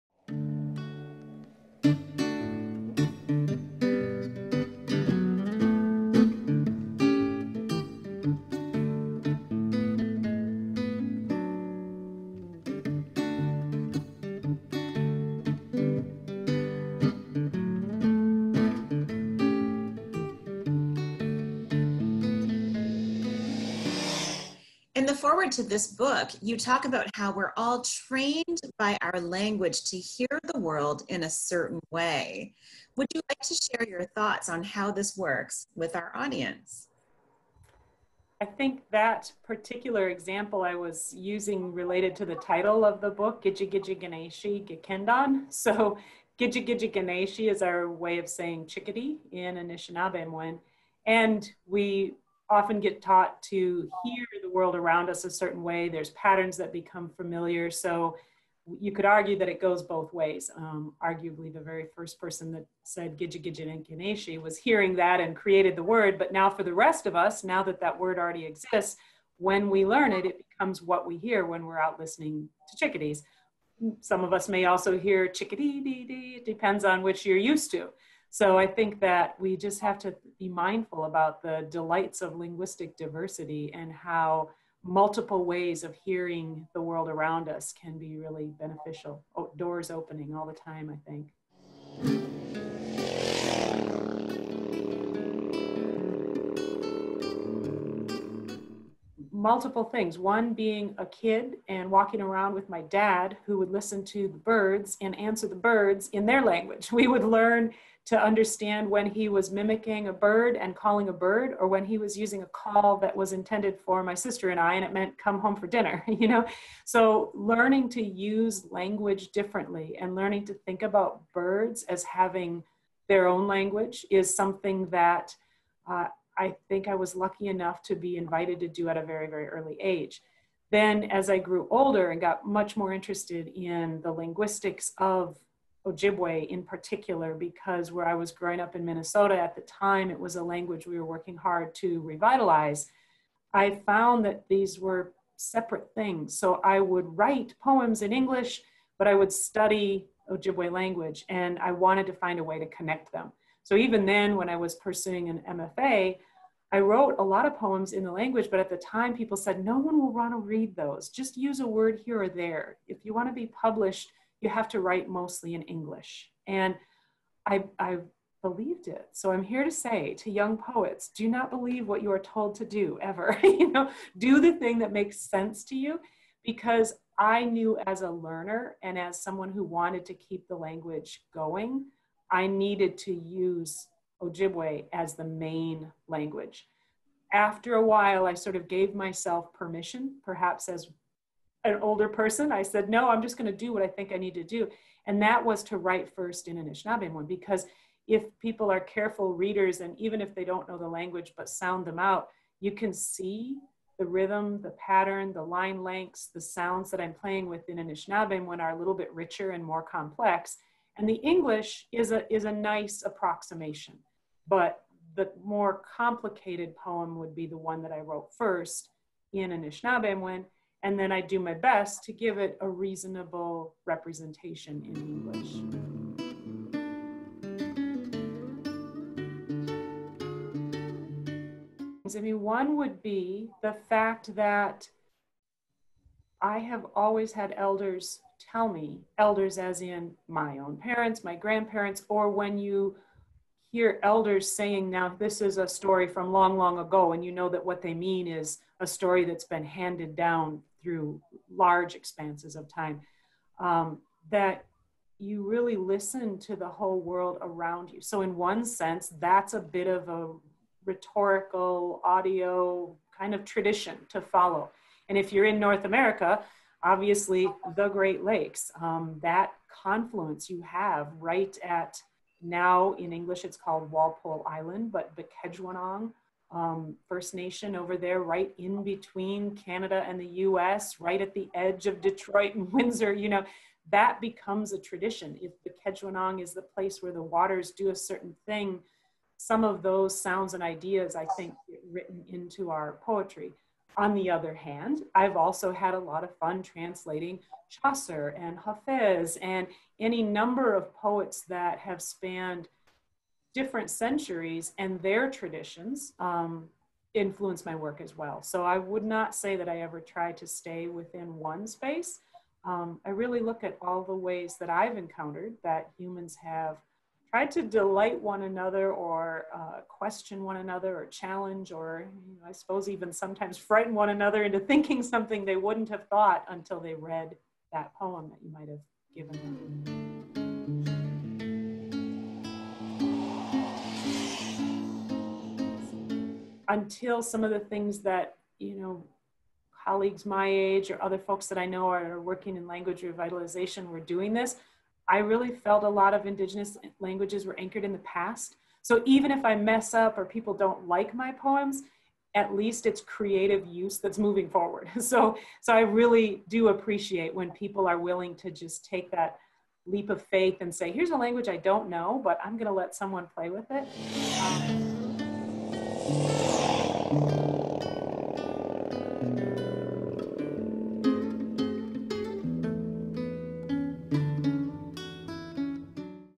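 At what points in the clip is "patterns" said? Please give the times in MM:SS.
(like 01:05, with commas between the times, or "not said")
00:56, 03:24.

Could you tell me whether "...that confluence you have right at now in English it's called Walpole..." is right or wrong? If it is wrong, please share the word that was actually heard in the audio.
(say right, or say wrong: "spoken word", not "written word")
right.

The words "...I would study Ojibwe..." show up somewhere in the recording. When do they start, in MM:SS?
02:29.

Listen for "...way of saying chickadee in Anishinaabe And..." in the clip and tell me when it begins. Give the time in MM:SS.
00:47.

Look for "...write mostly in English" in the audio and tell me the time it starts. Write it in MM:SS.
02:44.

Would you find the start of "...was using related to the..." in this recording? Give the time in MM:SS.
00:40.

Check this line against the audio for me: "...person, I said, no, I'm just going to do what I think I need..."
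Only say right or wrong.
right.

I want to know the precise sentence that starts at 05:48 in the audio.
So even if I mess up or people don't like my poems, at least it's creative use that's moving forward.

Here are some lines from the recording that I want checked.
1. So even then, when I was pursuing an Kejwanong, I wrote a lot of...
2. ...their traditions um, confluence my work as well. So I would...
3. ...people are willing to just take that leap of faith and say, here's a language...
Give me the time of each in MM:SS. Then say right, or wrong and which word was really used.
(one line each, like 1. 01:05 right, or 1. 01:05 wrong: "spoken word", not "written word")
1. 02:33 wrong: "MFA", not "Kejwanong"
2. 05:05 wrong: "influence", not "confluence"
3. 05:57 right.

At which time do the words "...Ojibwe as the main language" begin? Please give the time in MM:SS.
03:04.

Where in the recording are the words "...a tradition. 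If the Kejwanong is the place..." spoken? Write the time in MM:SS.
04:44.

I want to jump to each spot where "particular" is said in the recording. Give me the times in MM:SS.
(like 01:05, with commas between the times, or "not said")
00:39, 02:16.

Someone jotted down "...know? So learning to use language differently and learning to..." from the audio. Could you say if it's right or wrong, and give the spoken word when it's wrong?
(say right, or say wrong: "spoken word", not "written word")
right.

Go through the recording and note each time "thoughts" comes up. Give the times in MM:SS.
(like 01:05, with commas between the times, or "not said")
00:34, 05:26.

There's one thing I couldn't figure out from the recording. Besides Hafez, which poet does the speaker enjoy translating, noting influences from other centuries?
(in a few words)
Chaucer.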